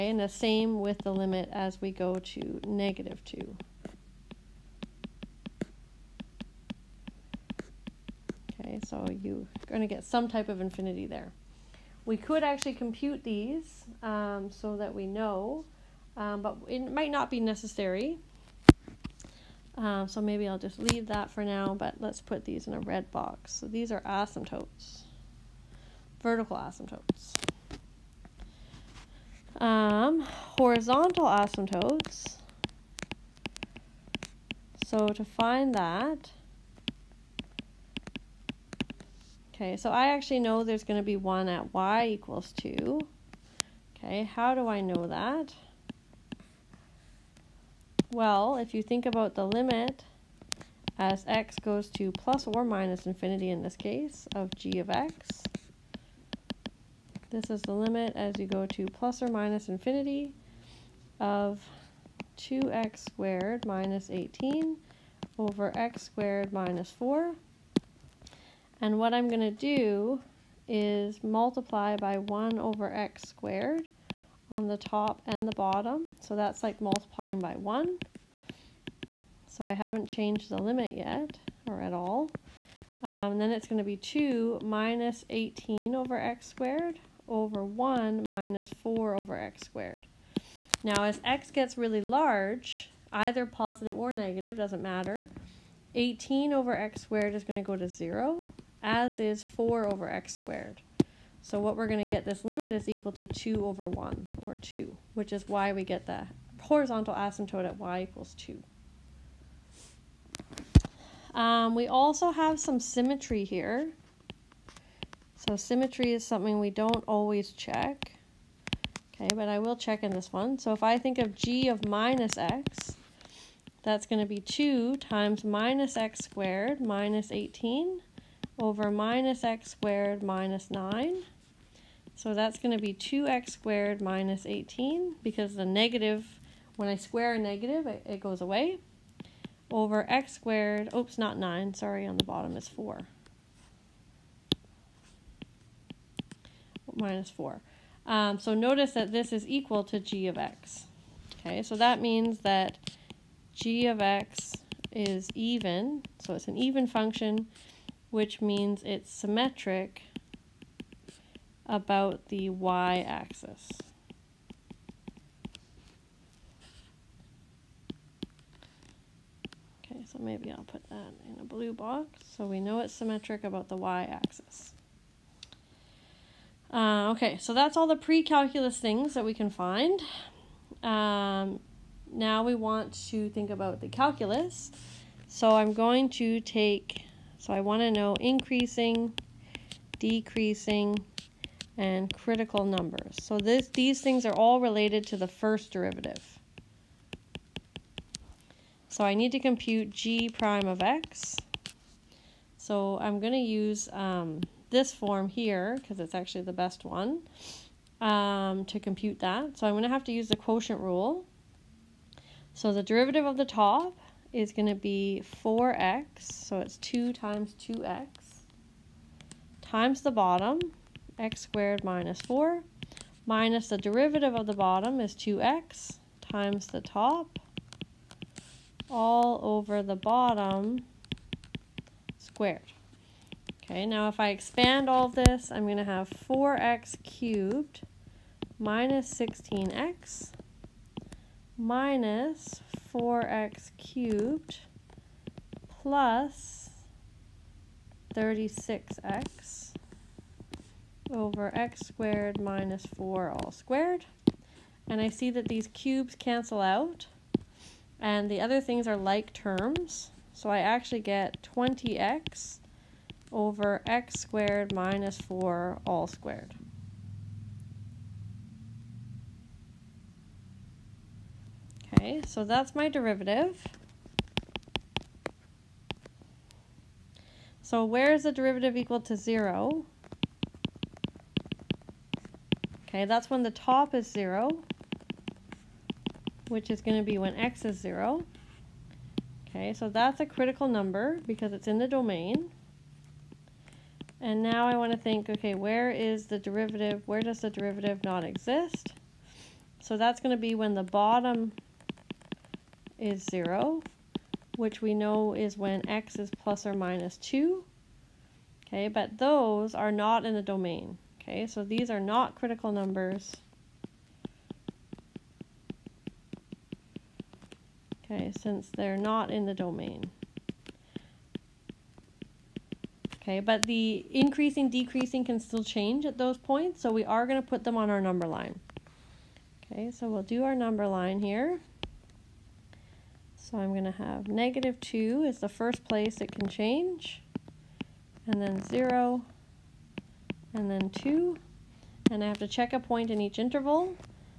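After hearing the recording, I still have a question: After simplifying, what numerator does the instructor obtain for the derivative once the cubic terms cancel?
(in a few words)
20x.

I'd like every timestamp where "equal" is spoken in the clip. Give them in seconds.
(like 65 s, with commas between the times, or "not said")
42 s, 102 s, 108 s, 149 s, 278 s.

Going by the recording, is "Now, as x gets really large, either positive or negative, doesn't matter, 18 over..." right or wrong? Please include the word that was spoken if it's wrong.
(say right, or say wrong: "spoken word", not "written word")
right.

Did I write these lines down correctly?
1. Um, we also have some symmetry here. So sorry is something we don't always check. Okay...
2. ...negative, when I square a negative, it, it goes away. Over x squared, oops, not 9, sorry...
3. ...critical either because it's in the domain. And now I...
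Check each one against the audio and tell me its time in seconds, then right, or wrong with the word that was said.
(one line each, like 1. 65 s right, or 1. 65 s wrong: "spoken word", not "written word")
1. 111 s wrong: "symmetry", not "sorry"
2. 135 s right
3. 290 s wrong: "number", not "either".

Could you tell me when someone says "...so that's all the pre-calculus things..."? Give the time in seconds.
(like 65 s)
177 s.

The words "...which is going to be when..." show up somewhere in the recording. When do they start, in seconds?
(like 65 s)
286 s.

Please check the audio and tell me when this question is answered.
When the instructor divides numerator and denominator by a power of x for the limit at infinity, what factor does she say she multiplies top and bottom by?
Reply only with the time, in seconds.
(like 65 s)
72 s.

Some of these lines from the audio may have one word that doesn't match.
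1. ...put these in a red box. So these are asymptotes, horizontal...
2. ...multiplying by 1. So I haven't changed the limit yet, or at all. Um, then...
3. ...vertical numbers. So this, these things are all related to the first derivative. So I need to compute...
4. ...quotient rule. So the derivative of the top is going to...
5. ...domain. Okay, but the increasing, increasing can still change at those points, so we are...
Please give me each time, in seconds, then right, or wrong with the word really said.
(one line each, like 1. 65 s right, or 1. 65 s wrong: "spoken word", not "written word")
1. 22 s wrong: "vertical", not "horizontal"
2. 76 s right
3. 192 s wrong: "critical", not "vertical"
4. 210 s right
5. 319 s wrong: "decreasing", not "increasing".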